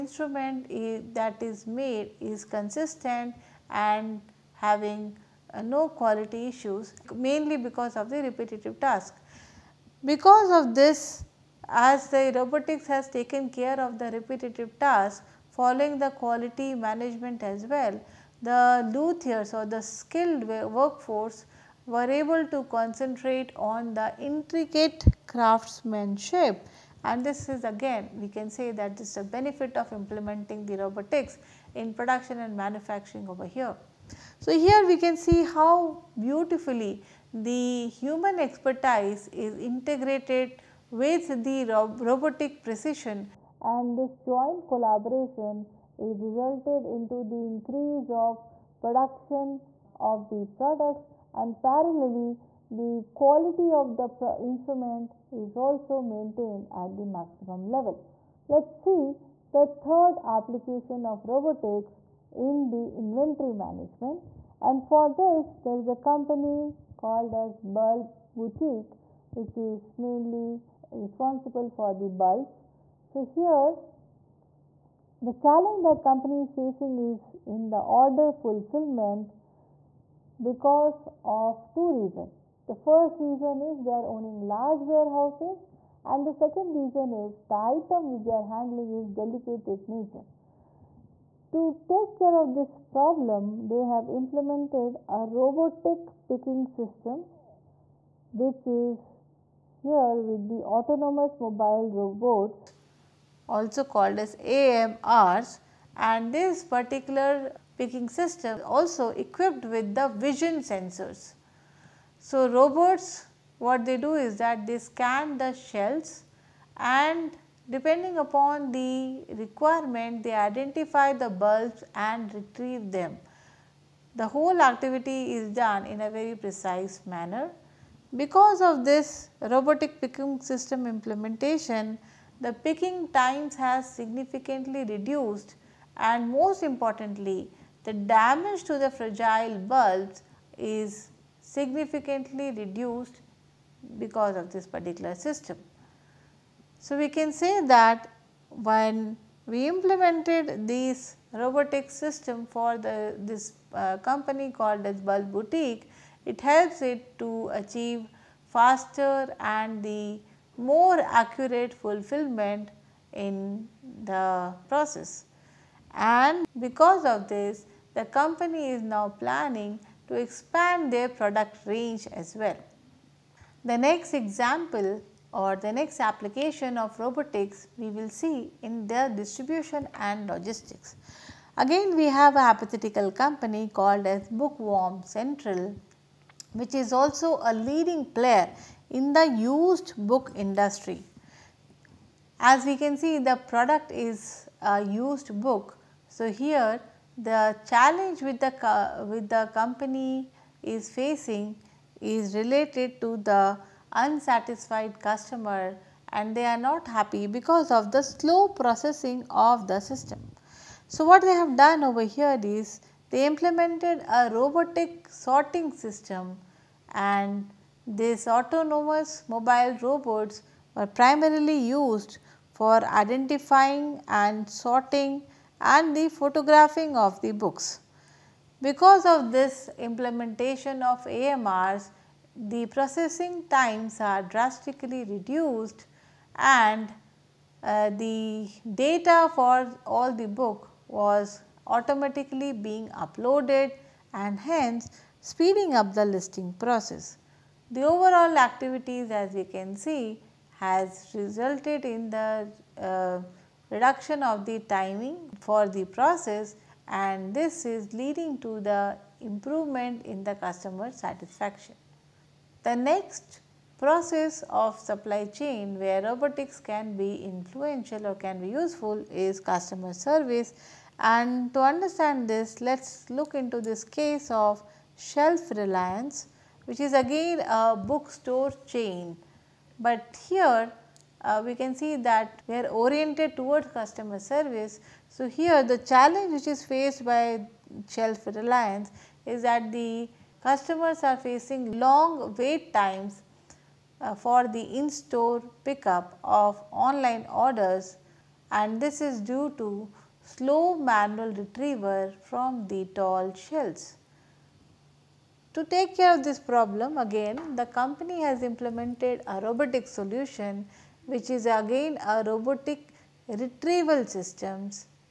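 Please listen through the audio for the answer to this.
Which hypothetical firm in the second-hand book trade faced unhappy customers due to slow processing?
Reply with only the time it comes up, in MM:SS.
03:04.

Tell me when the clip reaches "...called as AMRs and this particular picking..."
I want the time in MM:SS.
01:43.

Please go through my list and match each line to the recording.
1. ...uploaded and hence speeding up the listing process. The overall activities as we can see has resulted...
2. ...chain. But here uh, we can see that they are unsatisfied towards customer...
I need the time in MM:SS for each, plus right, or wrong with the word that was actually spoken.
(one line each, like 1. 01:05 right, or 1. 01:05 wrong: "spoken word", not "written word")
1. 04:02 right
2. 04:38 wrong: "oriented", not "unsatisfied".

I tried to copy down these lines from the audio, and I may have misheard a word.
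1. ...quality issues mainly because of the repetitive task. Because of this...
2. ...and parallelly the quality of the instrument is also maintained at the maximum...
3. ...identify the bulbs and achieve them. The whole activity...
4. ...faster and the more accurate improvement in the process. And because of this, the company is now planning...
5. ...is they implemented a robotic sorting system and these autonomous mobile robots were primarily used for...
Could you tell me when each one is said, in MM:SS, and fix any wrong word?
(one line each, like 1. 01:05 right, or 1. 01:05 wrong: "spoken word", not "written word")
1. 00:05 right
2. 00:51 right
3. 02:00 wrong: "retrieve", not "achieve"
4. 02:38 wrong: "fulfillment", not "improvement"
5. 03:32 right.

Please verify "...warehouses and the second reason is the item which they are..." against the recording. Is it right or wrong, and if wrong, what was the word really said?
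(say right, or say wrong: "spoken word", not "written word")
right.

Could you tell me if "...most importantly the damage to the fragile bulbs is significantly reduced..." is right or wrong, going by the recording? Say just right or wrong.
right.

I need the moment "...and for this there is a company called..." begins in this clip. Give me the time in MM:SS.
01:04.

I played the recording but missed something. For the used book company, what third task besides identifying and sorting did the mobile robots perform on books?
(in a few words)
photographing.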